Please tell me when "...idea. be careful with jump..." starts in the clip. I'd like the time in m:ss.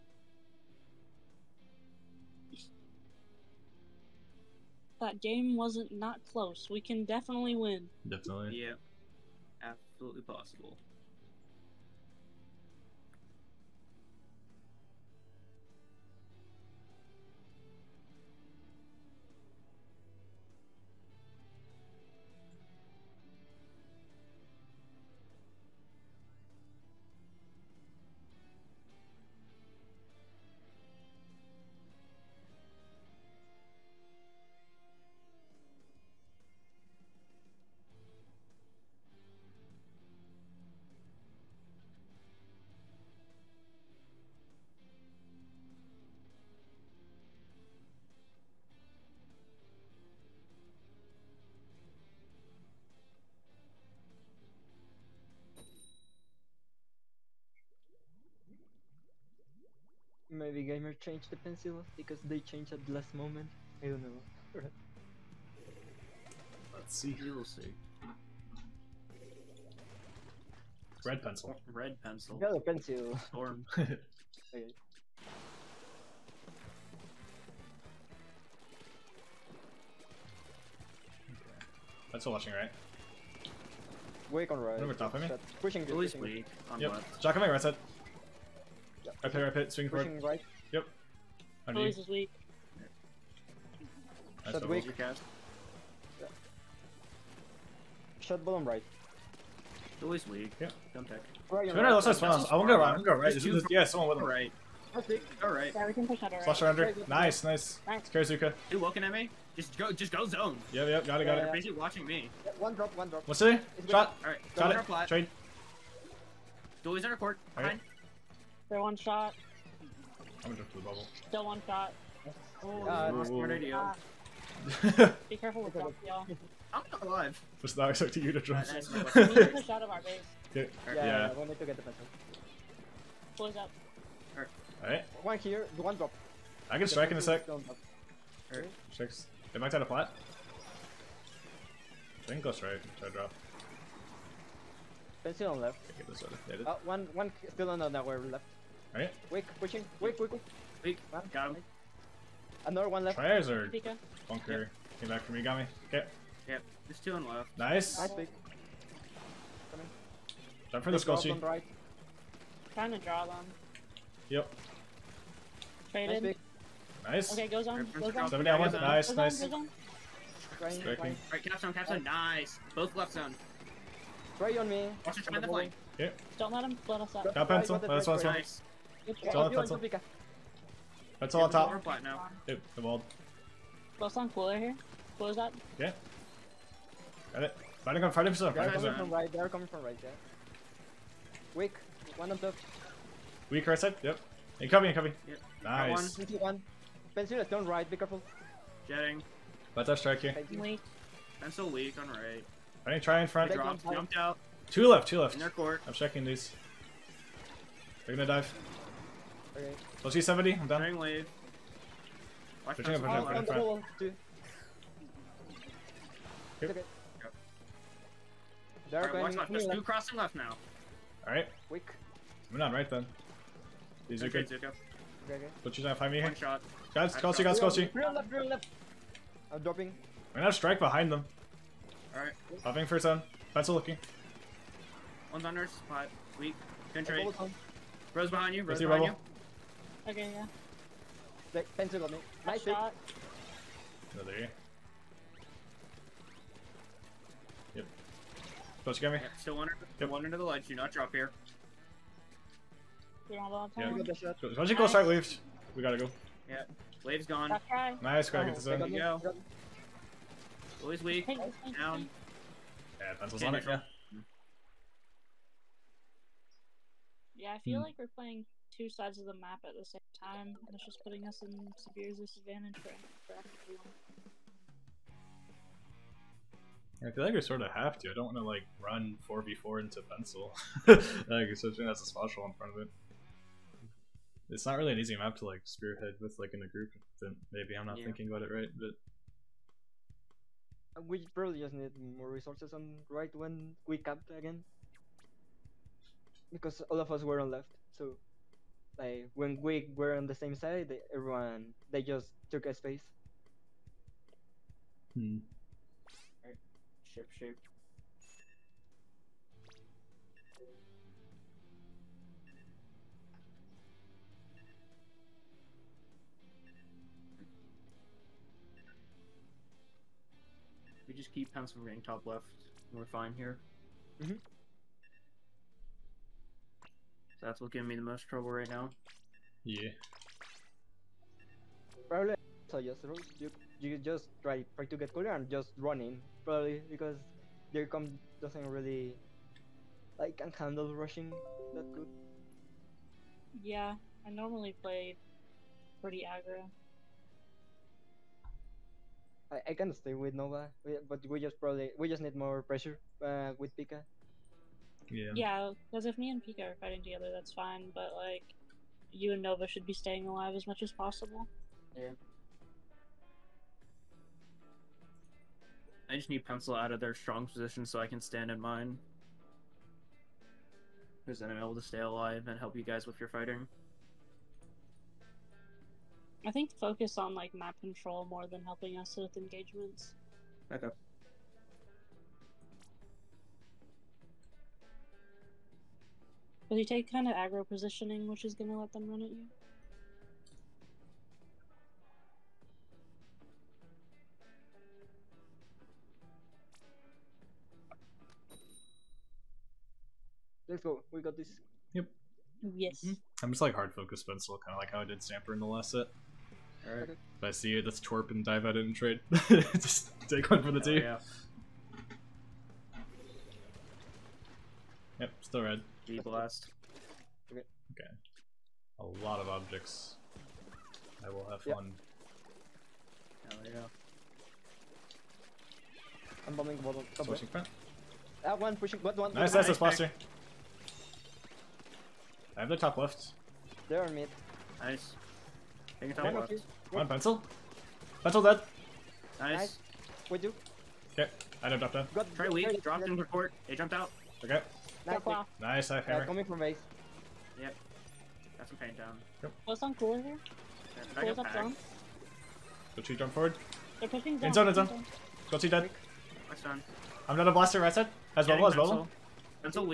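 2:03.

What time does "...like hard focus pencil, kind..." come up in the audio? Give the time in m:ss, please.
6:43.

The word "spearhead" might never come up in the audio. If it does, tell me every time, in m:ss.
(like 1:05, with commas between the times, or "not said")
4:45.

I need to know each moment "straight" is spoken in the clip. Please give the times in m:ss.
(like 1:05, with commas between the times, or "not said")
2:22.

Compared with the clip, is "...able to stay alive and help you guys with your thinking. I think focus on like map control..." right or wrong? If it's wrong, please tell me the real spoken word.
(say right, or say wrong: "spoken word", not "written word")
wrong: "fighting", not "thinking".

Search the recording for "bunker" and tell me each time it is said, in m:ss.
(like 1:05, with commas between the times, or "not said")
2:34.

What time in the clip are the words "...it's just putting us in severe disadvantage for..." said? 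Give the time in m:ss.
4:30.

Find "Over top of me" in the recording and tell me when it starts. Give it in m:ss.
1:24.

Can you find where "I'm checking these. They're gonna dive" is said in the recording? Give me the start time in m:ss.
3:25.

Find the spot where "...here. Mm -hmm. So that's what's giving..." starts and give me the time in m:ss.
5:23.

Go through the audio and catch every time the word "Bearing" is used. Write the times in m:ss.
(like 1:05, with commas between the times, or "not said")
3:30.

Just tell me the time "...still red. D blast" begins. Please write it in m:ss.
6:55.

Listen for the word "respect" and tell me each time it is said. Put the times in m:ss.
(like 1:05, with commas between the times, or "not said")
not said.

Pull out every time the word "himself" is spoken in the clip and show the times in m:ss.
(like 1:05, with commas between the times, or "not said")
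3:08.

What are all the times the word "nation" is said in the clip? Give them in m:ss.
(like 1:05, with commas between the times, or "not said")
not said.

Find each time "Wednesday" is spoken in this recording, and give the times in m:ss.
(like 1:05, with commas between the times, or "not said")
not said.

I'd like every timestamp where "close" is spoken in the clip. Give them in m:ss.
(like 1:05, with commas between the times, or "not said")
0:06, 2:13, 4:08.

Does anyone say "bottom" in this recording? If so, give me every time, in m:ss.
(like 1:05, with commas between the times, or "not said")
1:38, 7:06.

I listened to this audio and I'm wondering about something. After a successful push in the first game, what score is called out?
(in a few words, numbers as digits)
7 down 1.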